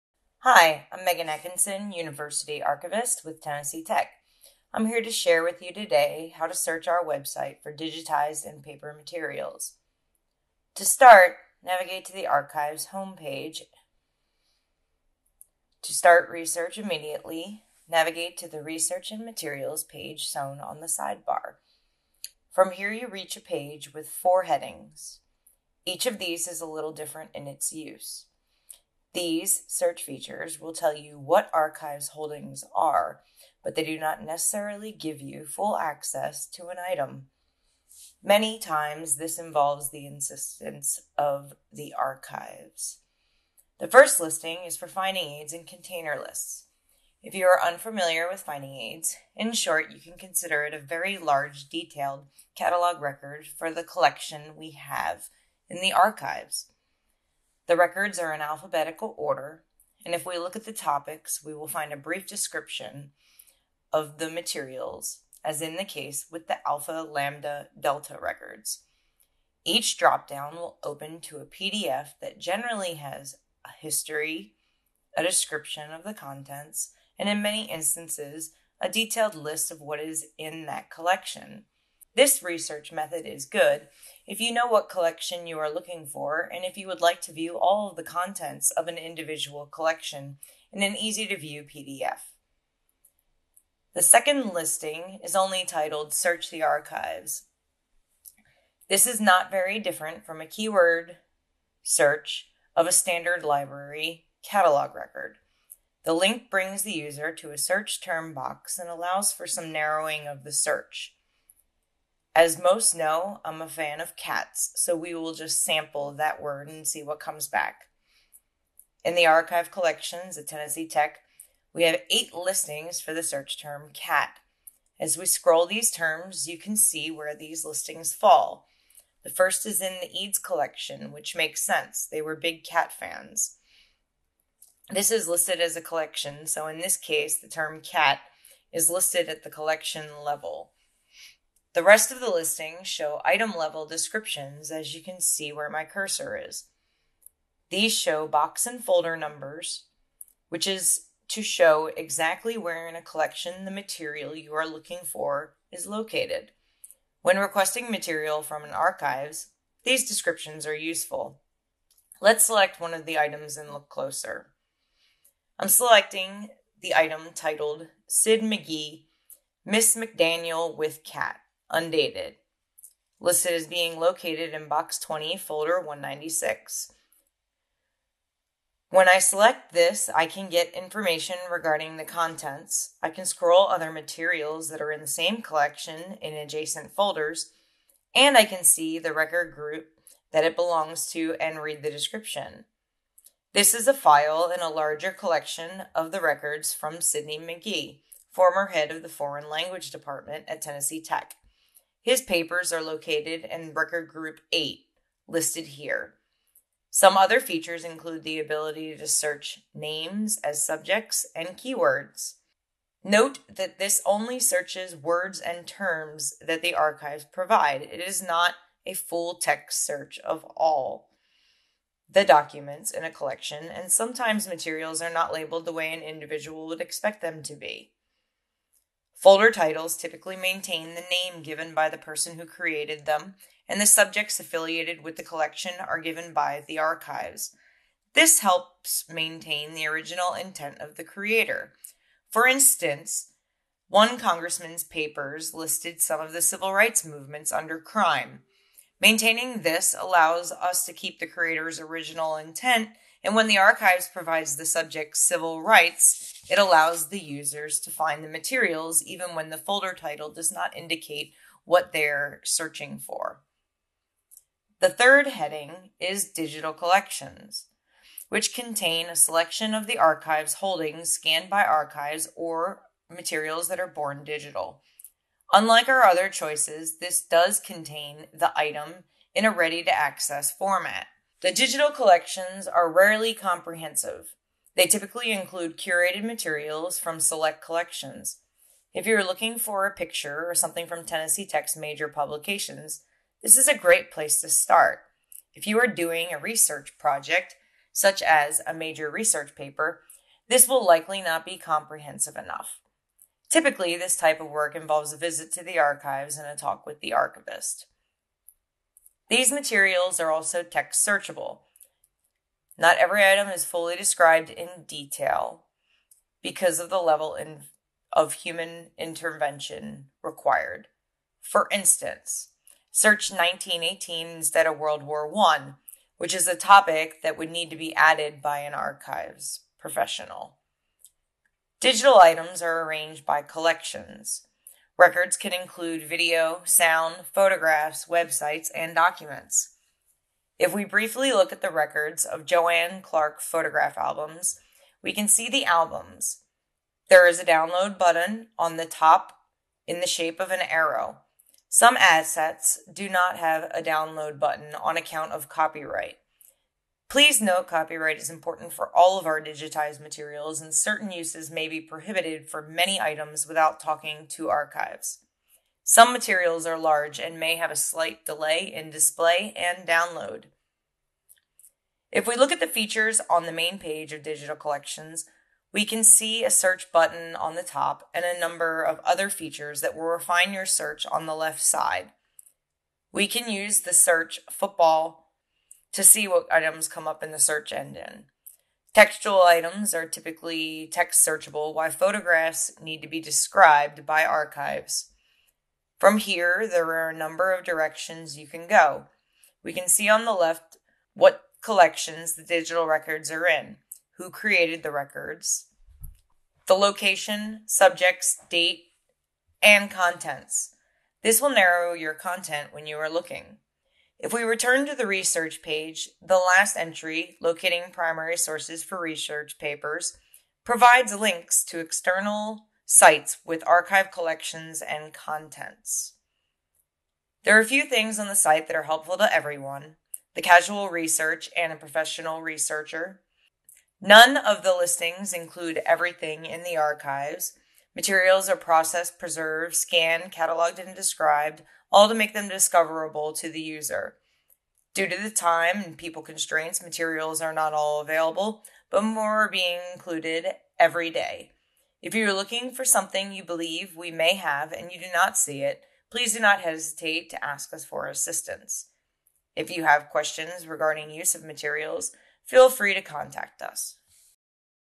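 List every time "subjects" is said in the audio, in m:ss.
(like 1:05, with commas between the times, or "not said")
3:30, 3:53, 4:14, 6:47.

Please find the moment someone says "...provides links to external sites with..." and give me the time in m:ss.
7:00.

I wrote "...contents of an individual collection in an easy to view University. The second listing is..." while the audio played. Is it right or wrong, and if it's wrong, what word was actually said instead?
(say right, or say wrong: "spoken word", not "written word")
wrong: "PDF", not "University".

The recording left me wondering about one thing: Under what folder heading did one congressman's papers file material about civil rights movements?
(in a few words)
crime.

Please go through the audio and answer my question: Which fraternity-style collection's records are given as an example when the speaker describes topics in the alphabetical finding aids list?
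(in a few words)
Alpha Lambda Delta.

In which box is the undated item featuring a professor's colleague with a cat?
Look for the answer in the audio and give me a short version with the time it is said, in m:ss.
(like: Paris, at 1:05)
20, at 2:54.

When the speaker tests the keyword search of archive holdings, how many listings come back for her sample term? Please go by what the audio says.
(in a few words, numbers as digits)
8.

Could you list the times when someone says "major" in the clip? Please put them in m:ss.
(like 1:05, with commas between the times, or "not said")
4:51, 4:58.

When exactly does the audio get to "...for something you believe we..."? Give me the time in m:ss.
7:32.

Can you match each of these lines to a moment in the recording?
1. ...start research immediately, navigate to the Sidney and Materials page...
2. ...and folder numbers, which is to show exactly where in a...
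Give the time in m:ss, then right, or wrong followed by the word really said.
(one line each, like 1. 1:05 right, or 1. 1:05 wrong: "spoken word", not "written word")
1. 0:15 wrong: "Research", not "Sidney"
2. 2:28 right.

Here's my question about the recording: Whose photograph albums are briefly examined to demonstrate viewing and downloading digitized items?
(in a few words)
Joanne Clark.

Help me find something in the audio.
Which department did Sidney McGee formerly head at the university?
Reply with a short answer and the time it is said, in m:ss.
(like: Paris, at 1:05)
Foreign Language Department, at 3:19.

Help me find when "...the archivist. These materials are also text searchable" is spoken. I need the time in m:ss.
5:06.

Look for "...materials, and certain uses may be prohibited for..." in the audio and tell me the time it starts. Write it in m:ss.
5:59.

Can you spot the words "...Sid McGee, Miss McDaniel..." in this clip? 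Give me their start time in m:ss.
2:48.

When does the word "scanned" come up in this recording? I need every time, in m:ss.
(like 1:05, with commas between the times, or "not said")
4:31, 7:19.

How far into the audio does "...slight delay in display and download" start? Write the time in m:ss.
6:07.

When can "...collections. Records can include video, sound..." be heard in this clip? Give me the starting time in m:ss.
5:33.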